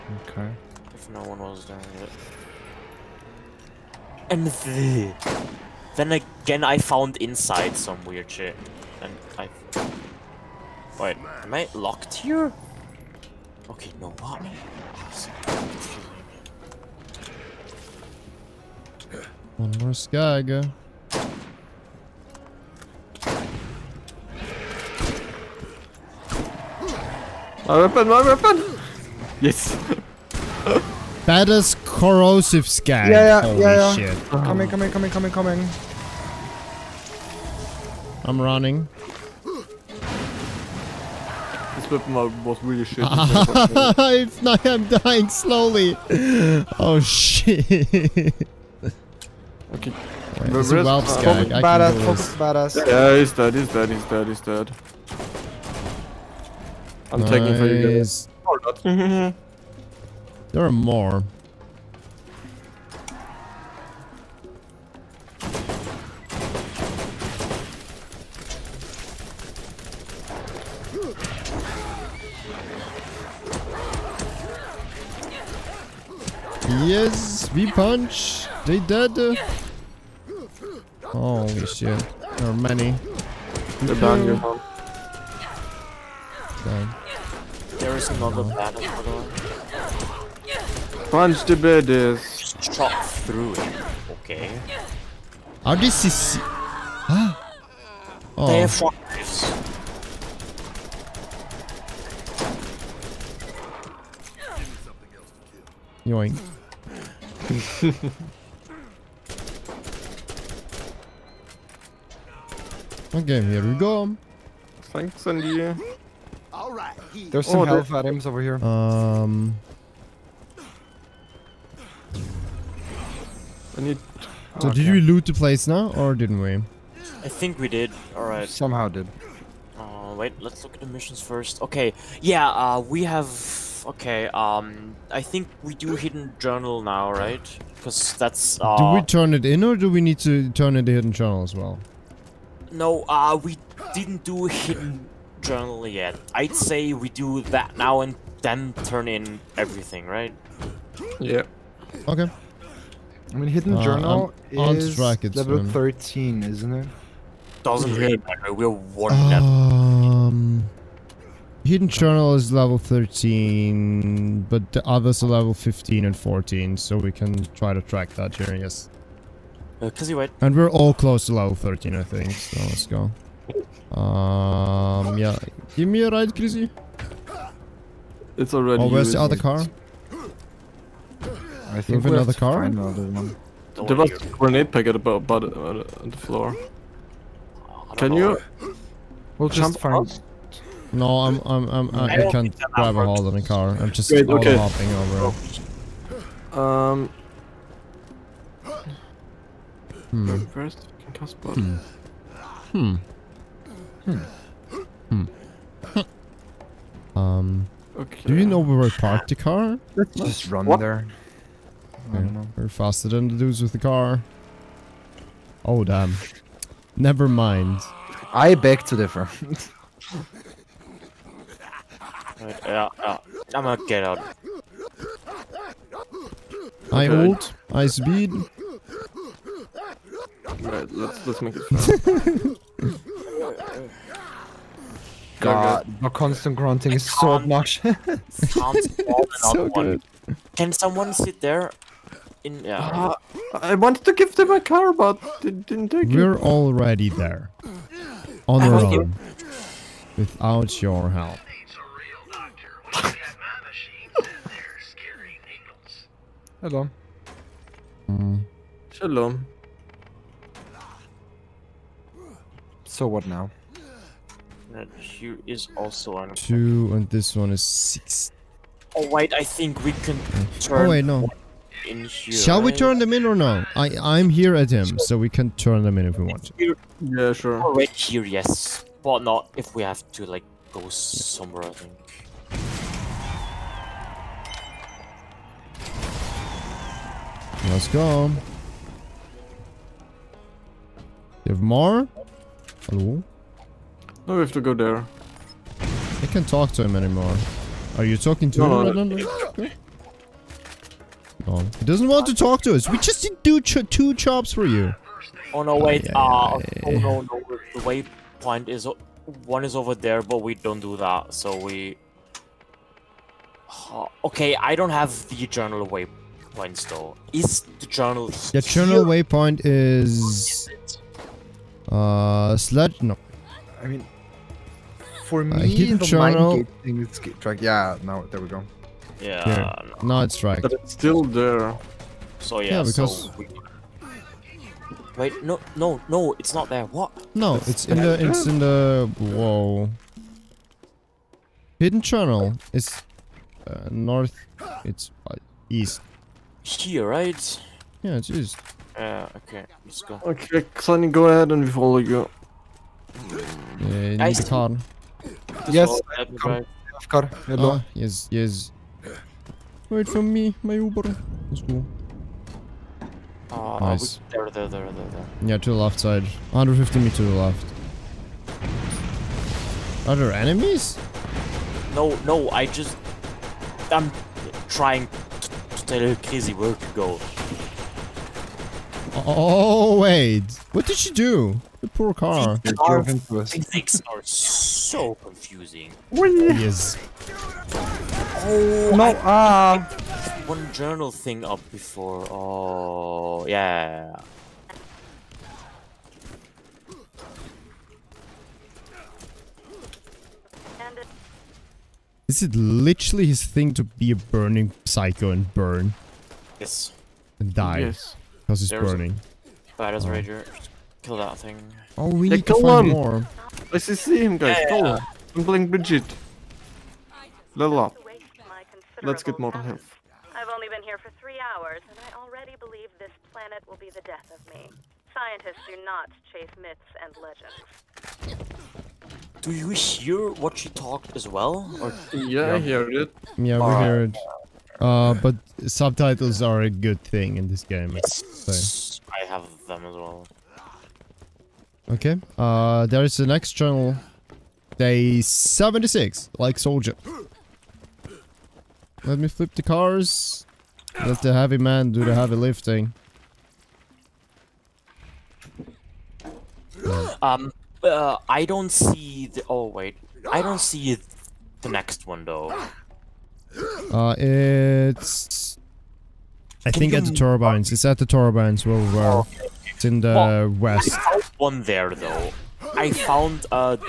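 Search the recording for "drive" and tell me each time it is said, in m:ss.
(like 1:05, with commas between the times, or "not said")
3:12.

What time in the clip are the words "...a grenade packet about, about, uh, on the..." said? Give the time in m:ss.
3:04.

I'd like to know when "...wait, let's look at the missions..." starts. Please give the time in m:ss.
2:10.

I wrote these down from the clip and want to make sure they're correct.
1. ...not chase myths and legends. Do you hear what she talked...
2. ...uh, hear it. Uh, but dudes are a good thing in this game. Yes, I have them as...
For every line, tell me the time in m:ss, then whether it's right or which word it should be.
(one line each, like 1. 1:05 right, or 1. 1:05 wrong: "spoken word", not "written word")
1. 7:05 right
2. 7:13 wrong: "subtitles", not "dudes".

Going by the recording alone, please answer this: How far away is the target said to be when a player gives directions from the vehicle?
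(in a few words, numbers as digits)
150 meters.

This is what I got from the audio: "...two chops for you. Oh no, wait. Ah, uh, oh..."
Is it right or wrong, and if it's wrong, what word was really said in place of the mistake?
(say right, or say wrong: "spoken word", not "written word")
right.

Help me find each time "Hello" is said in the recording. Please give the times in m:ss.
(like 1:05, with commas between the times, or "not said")
4:52, 5:57.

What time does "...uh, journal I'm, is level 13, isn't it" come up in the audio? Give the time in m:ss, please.
2:33.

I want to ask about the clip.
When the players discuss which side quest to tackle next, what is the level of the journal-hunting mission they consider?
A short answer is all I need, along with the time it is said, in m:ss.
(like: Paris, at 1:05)
13, at 2:41.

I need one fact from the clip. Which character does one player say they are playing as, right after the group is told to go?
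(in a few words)
Bridget.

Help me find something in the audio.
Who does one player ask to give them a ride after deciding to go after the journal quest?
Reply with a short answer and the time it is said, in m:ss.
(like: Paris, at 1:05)
Krizzy, at 2:55.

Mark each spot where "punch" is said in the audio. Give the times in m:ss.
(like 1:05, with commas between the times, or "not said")
1:17, 1:31.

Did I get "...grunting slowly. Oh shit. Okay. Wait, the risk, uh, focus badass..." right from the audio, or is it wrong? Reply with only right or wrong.
wrong.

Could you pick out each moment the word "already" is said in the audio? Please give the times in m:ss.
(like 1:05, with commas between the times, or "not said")
2:58, 4:06, 7:02.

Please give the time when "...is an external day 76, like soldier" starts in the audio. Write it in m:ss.
7:23.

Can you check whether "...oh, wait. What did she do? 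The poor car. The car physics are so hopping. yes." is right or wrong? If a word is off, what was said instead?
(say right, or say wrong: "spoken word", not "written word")
wrong: "confusing", not "hopping".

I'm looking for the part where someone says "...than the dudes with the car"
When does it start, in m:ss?
3:33.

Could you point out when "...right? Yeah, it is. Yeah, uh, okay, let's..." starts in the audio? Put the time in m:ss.
5:47.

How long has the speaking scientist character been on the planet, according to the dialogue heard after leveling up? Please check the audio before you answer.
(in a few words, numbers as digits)
3 hours.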